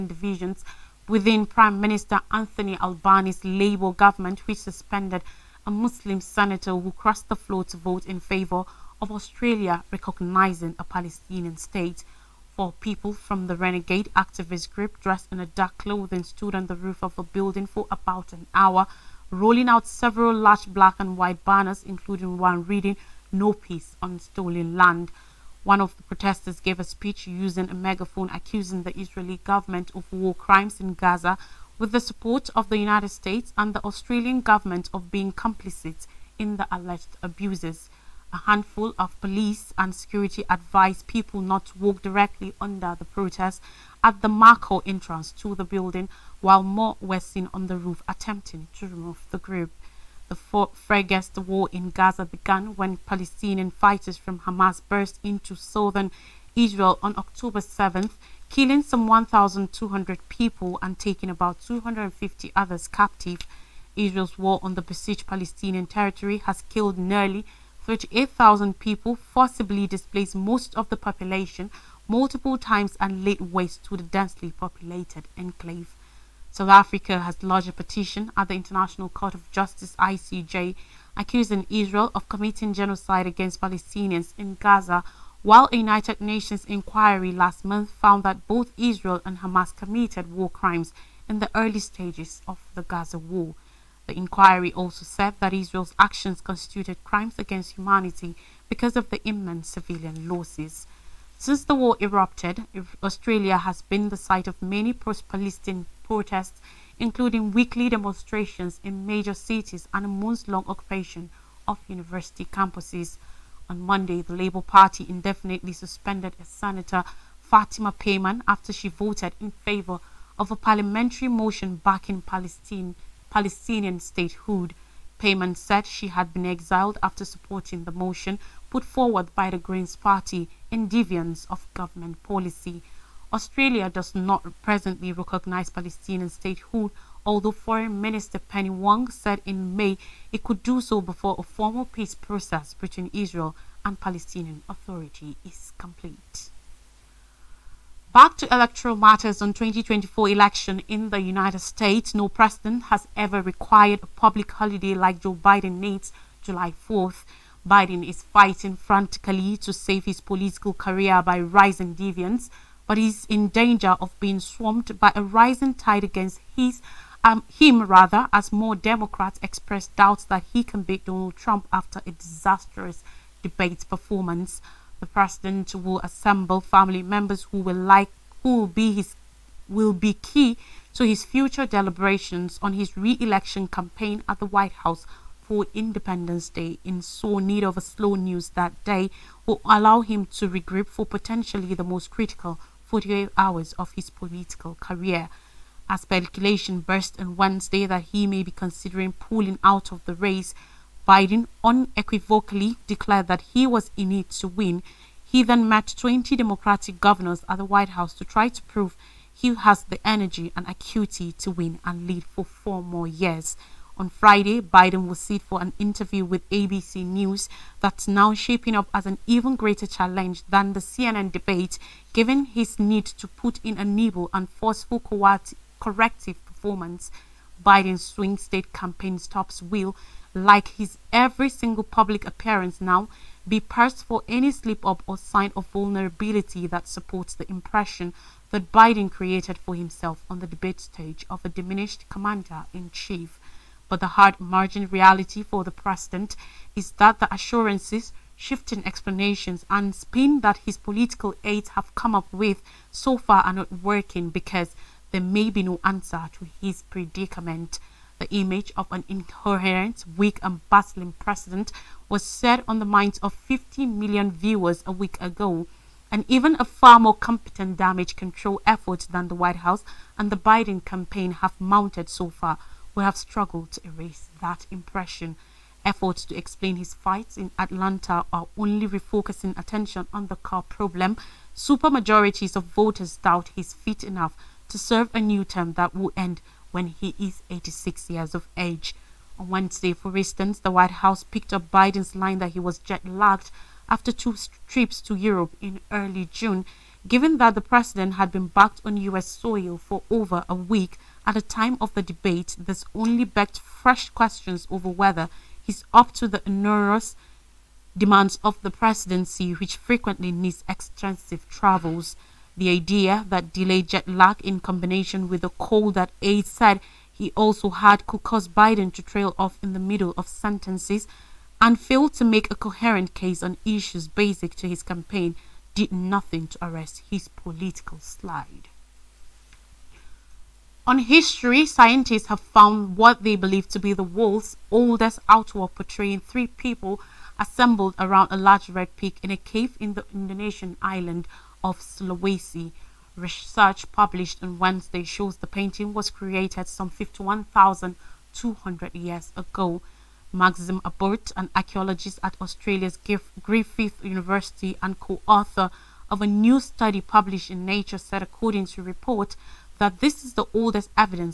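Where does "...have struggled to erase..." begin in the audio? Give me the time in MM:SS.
04:33.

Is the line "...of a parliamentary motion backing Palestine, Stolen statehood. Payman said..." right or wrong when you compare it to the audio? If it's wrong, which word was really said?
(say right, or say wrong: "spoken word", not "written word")
wrong: "Palestinian", not "Stolen".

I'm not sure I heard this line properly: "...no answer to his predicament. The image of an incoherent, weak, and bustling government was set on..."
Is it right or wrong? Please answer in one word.
wrong.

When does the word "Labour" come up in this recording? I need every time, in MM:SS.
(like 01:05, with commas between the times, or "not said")
00:03, 01:54.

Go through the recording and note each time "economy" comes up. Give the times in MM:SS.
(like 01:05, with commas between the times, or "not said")
not said.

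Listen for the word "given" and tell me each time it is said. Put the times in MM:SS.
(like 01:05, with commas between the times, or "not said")
03:42, 04:57.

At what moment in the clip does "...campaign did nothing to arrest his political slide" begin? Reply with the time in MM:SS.
05:24.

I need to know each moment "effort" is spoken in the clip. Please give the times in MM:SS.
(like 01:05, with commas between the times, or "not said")
04:28, 04:35.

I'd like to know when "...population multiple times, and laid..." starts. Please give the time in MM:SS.
01:10.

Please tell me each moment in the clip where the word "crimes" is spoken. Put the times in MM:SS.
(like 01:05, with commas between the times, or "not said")
00:30, 01:30, 01:37.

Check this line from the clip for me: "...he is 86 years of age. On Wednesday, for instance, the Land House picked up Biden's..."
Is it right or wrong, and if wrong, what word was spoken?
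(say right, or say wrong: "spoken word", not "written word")
wrong: "White", not "Land".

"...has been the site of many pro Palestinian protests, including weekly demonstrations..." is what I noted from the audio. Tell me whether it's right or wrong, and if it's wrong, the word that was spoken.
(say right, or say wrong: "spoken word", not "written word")
right.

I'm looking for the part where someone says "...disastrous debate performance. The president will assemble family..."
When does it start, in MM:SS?
02:52.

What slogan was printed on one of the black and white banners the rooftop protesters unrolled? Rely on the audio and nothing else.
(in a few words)
No Peace on Stolen Land.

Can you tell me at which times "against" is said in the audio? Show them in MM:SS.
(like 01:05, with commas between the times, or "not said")
01:23, 01:37, 02:46.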